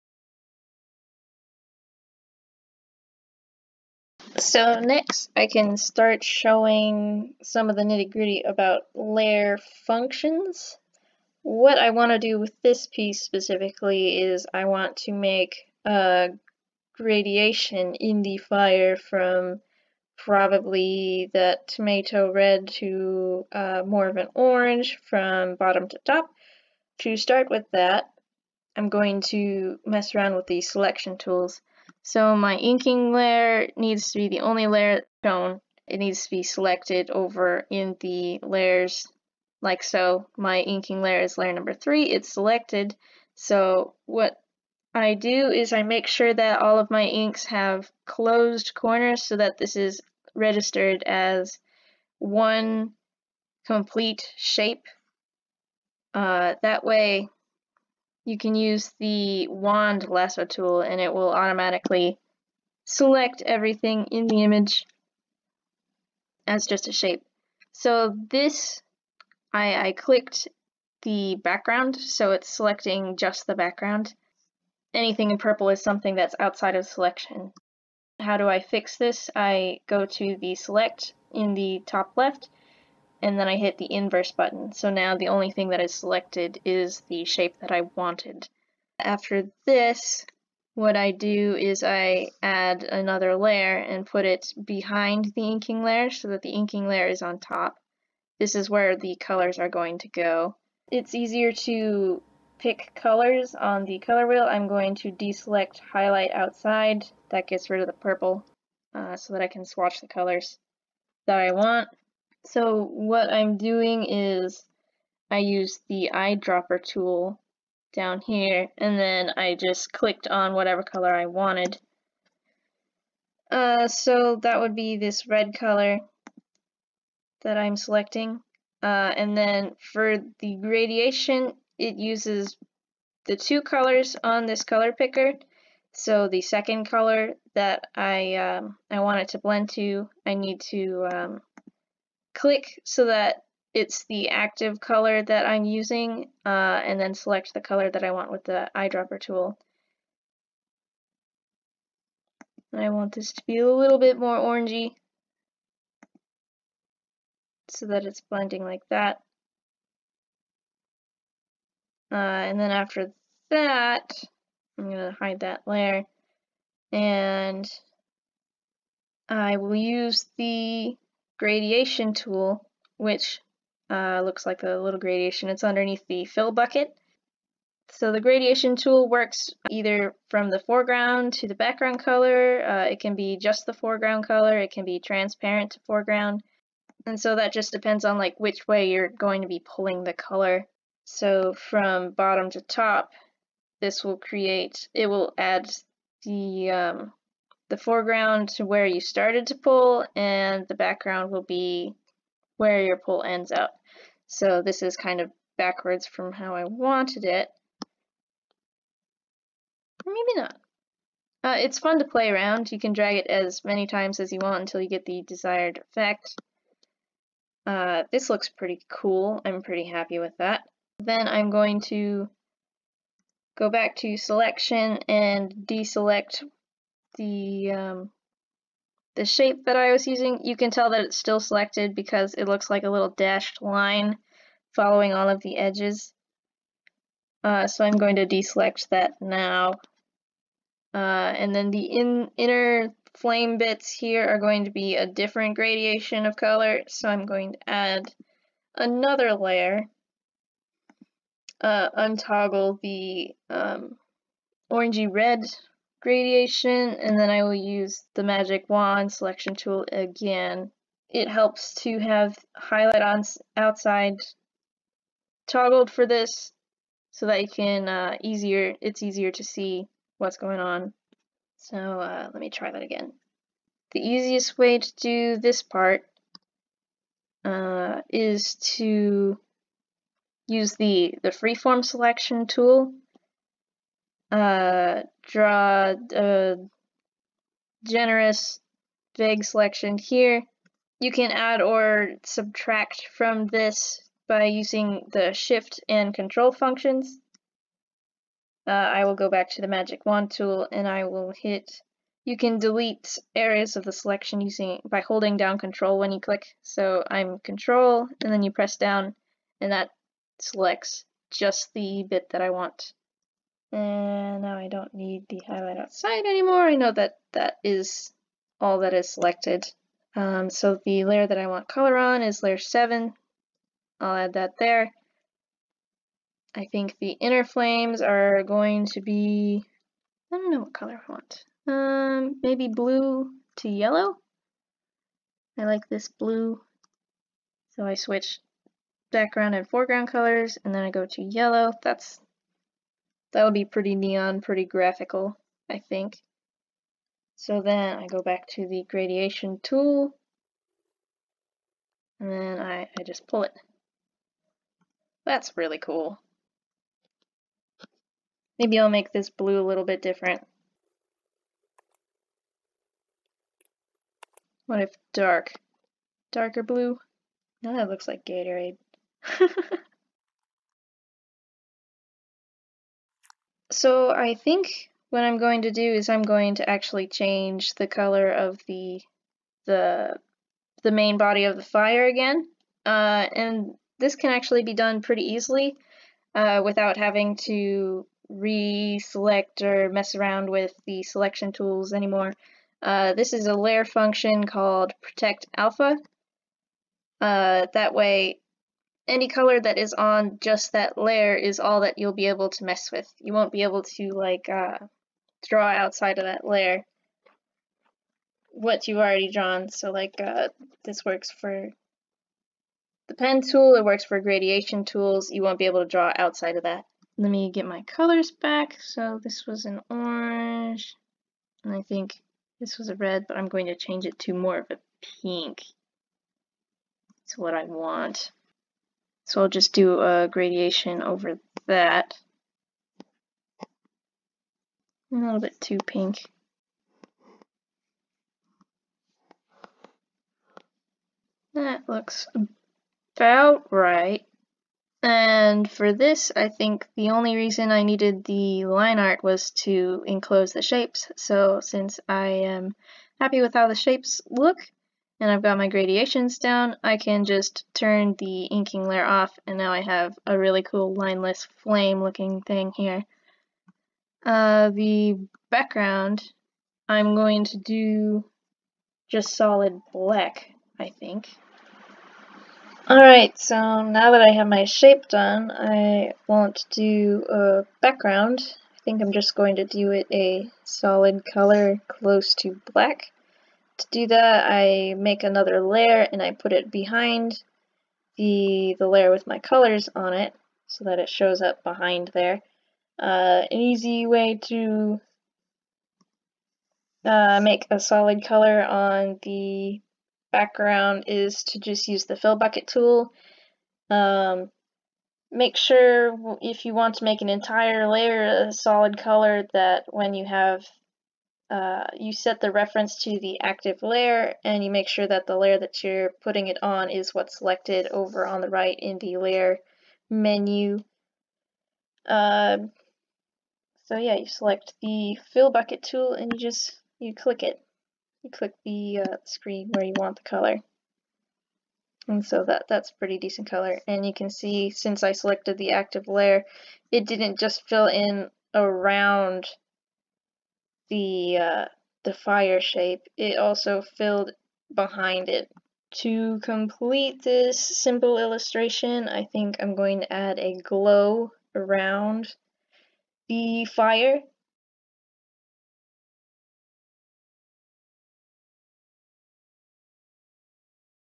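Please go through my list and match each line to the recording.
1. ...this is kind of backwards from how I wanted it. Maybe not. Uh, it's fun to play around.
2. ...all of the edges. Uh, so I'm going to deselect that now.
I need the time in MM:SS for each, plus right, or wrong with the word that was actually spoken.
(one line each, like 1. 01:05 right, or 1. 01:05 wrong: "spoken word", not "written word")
1. 03:24 right
2. 03:55 right.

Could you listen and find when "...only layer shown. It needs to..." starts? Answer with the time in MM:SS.
00:34.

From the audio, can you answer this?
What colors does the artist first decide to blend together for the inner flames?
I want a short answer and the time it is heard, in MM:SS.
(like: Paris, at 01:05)
Blue to yellow, at 05:32.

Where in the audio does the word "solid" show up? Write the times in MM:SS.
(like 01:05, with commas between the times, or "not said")
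07:49, 08:00, 08:17, 08:28.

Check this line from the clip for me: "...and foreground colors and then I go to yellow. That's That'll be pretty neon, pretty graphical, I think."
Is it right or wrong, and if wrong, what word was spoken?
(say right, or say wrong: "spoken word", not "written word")
right.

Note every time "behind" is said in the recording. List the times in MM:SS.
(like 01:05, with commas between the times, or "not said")
01:34, 08:06, 08:11, 09:04.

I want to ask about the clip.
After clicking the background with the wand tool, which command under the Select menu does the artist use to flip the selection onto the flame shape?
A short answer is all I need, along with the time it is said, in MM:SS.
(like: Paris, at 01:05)
Inverse, at 01:23.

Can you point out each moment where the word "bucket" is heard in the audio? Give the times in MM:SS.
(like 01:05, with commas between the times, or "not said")
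02:56, 08:22, 08:45.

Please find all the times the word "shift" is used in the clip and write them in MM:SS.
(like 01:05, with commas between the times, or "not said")
04:55.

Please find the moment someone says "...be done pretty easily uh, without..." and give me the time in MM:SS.
06:24.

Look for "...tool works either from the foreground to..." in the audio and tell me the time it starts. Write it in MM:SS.
02:58.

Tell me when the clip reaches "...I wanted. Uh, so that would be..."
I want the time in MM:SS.
02:01.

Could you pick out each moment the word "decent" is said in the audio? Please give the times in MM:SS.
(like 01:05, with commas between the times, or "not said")
08:53.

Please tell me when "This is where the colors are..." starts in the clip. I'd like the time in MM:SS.
01:38.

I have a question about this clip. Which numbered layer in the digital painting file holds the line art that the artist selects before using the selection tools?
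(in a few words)
Layer 3.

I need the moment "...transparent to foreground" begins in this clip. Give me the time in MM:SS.
03:04.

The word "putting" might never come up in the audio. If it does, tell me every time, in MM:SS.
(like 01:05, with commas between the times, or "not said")
08:36.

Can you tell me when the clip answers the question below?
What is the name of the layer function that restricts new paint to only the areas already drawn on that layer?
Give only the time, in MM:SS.
06:35.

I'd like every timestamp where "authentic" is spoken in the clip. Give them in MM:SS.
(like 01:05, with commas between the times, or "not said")
not said.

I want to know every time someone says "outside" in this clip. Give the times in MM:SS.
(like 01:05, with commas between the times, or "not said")
01:16, 01:46, 04:23, 05:15, 06:45, 06:56.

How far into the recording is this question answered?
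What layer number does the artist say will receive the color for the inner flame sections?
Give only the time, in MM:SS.
05:22.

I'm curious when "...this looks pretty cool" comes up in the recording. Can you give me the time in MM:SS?
03:38.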